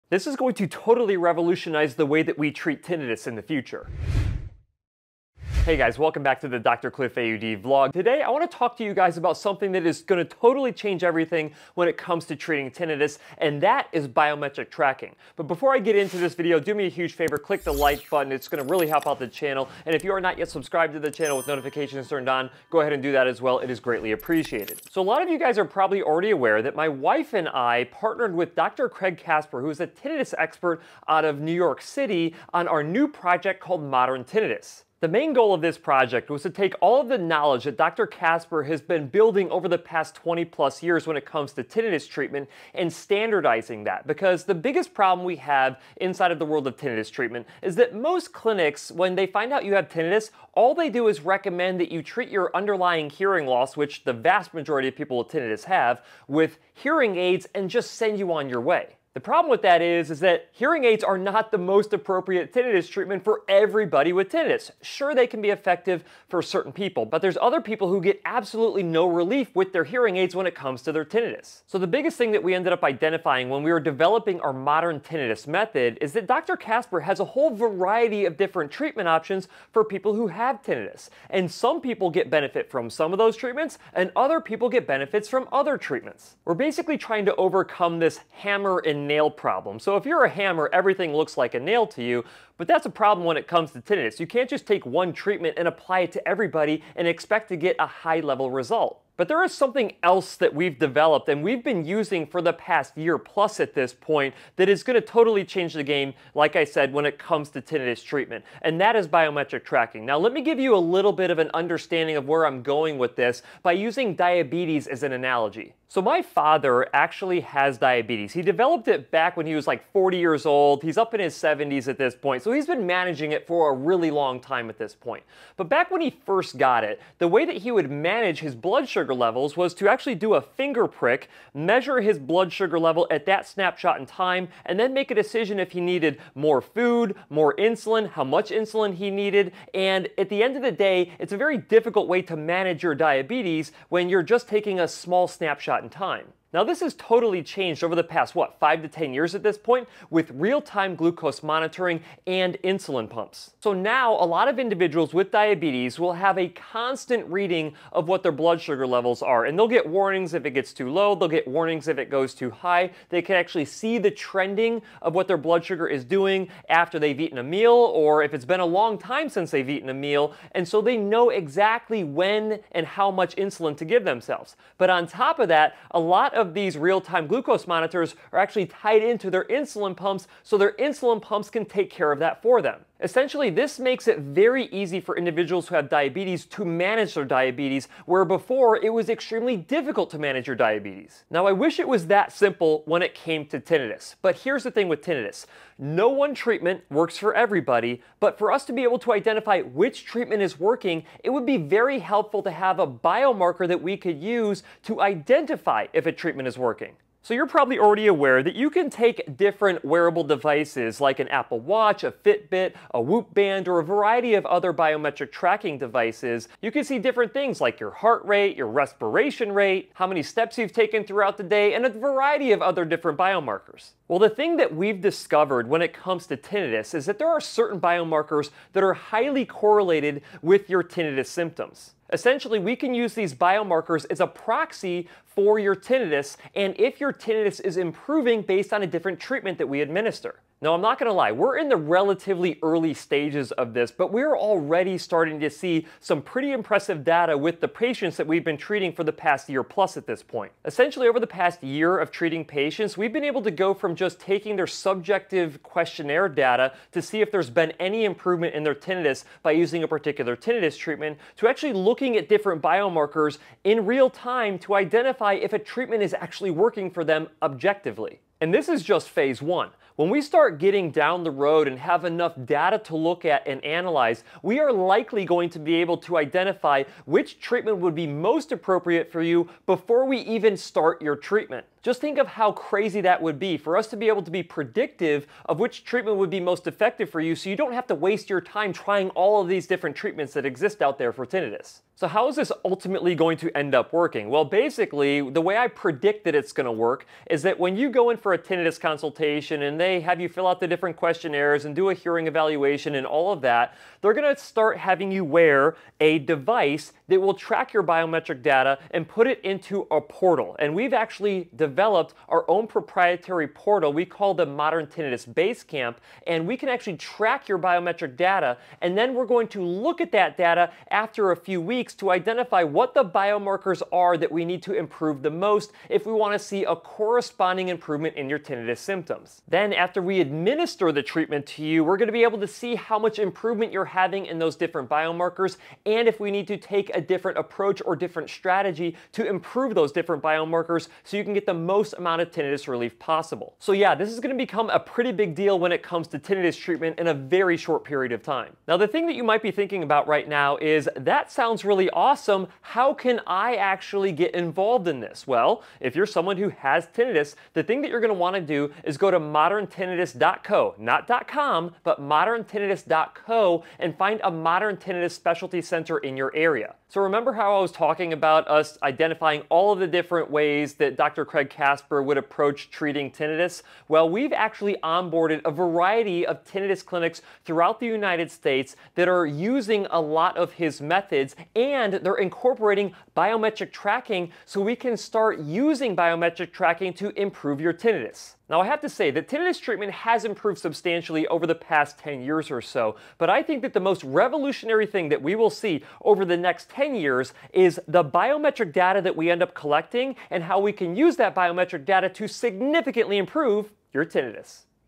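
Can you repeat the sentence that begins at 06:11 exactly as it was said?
Craig Kasper would approach treating tinnitus?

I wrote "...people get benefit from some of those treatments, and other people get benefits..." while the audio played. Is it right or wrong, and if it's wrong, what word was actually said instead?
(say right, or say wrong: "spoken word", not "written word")
right.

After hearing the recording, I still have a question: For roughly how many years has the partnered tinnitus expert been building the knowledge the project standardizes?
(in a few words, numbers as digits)
20 plus years.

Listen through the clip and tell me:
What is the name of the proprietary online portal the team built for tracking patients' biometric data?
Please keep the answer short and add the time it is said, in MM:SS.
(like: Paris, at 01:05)
Modern Tinnitus Basecamp, at 05:14.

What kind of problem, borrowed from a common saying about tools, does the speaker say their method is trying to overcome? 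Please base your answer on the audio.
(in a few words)
hammer and nail problem.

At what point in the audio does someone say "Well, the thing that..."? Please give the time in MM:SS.
03:44.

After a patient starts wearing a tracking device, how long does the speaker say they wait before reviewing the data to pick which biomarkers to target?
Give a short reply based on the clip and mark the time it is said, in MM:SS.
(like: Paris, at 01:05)
a few weeks, at 05:21.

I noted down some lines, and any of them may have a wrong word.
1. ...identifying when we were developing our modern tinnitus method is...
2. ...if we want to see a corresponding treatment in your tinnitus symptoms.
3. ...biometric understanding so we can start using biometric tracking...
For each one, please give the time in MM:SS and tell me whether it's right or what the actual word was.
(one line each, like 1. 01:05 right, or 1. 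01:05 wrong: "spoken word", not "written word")
1. 01:12 right
2. 05:25 wrong: "improvement", not "treatment"
3. 06:23 wrong: "tracking", not "understanding".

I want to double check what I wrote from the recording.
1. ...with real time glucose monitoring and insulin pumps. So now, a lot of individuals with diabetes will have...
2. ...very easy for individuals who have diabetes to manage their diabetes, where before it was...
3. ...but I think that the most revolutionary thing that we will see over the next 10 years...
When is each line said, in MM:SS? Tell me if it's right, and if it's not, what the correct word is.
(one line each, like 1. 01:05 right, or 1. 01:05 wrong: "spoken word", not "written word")
1. 02:30 right
2. 03:04 right
3. 06:33 right.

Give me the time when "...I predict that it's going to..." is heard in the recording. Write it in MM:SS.
04:55.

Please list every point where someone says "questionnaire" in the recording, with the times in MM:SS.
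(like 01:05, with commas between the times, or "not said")
04:15, 05:00.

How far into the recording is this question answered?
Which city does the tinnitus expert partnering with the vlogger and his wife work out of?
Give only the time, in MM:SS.
00:31.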